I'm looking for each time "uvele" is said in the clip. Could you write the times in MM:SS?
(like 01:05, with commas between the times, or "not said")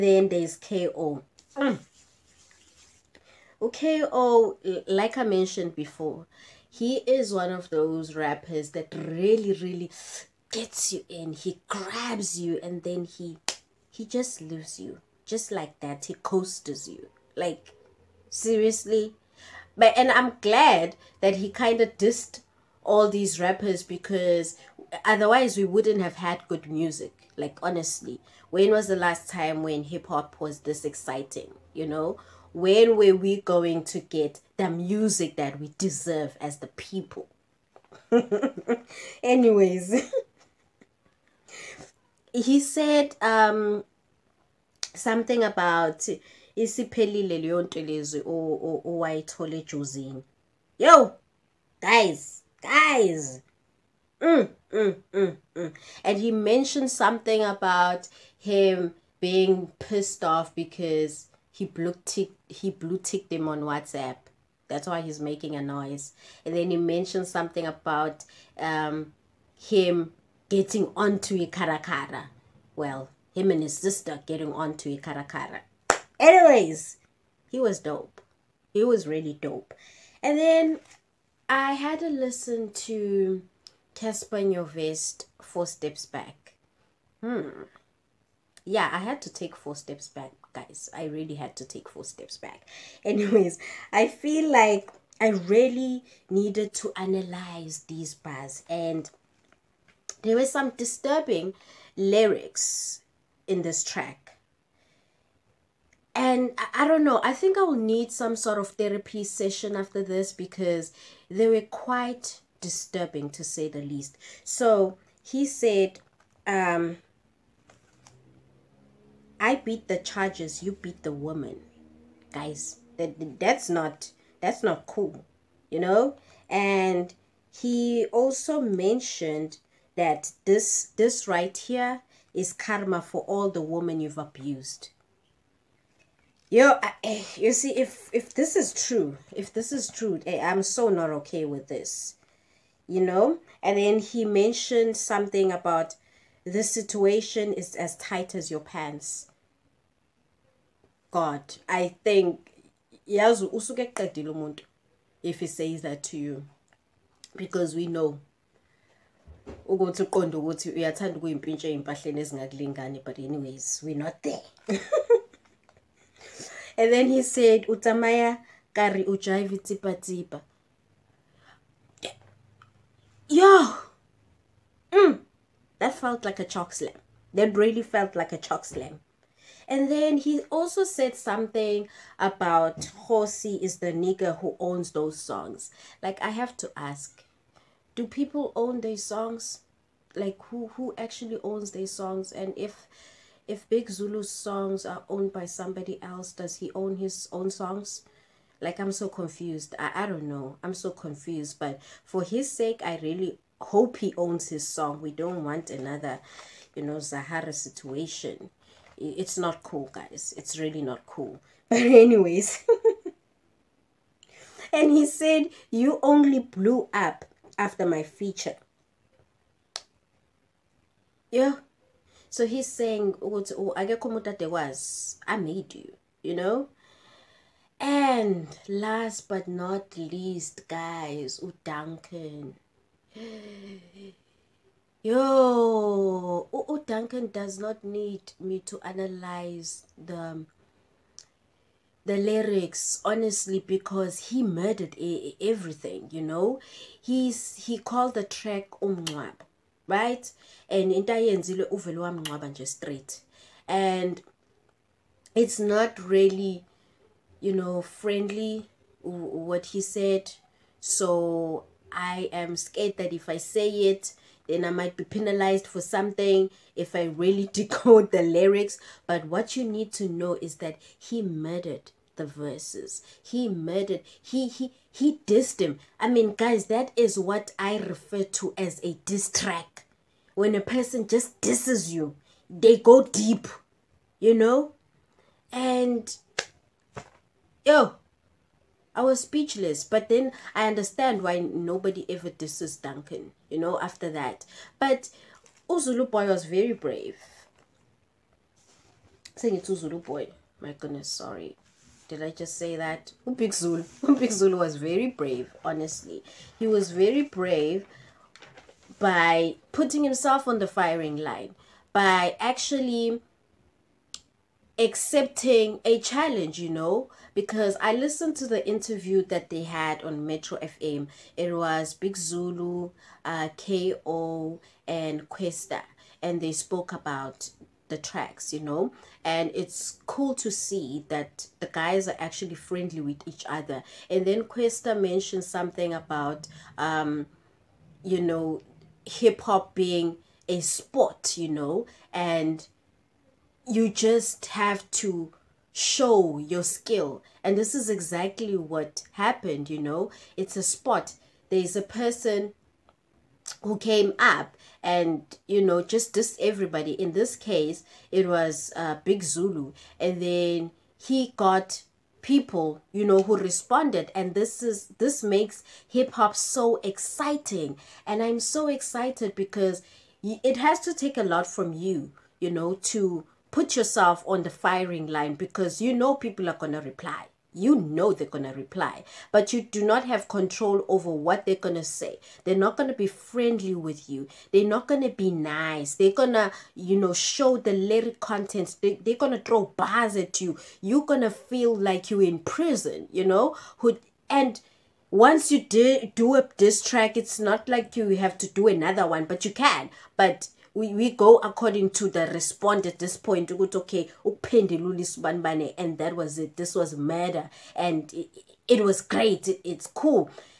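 04:11.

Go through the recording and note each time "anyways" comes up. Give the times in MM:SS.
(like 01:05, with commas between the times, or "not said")
00:39, 01:16, 01:33, 02:43, 03:31.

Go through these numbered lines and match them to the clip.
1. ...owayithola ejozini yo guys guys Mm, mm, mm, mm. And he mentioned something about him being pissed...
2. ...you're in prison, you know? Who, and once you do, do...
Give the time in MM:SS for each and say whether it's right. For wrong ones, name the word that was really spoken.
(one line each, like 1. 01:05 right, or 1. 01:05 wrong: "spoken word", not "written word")
1. 00:48 right
2. 06:32 right.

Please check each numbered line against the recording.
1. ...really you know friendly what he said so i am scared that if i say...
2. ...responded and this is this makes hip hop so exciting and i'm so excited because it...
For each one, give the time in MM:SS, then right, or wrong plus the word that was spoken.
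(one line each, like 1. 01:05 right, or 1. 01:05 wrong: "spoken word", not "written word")
1. 04:15 right
2. 06:03 right.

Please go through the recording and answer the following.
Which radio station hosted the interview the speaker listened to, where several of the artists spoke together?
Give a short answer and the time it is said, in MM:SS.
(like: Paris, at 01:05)
Metro FM, at 05:20.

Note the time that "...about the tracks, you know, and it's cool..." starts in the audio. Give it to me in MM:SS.
05:26.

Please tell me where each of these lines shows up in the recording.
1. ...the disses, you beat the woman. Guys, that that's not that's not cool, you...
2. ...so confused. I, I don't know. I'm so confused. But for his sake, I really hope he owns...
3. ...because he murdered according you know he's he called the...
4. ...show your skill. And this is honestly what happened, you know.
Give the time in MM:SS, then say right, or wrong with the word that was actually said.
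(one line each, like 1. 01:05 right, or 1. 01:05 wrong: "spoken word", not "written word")
1. 01:59 wrong: "charges", not "disses"
2. 03:18 right
3. 04:03 wrong: "everything", not "according"
4. 05:45 wrong: "exactly", not "honestly".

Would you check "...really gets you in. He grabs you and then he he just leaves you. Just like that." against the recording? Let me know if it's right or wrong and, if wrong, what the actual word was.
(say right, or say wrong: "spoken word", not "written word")
right.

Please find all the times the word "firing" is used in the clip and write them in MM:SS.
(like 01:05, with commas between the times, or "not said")
05:10, 06:14.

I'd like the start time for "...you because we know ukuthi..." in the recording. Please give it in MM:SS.
02:36.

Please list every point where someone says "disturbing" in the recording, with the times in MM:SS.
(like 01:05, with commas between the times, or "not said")
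01:40, 01:52.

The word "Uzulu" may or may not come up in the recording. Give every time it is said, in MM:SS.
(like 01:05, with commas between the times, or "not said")
04:55, 04:59.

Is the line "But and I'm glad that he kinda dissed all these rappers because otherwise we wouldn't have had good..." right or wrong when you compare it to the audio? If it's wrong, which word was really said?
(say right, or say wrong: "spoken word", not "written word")
right.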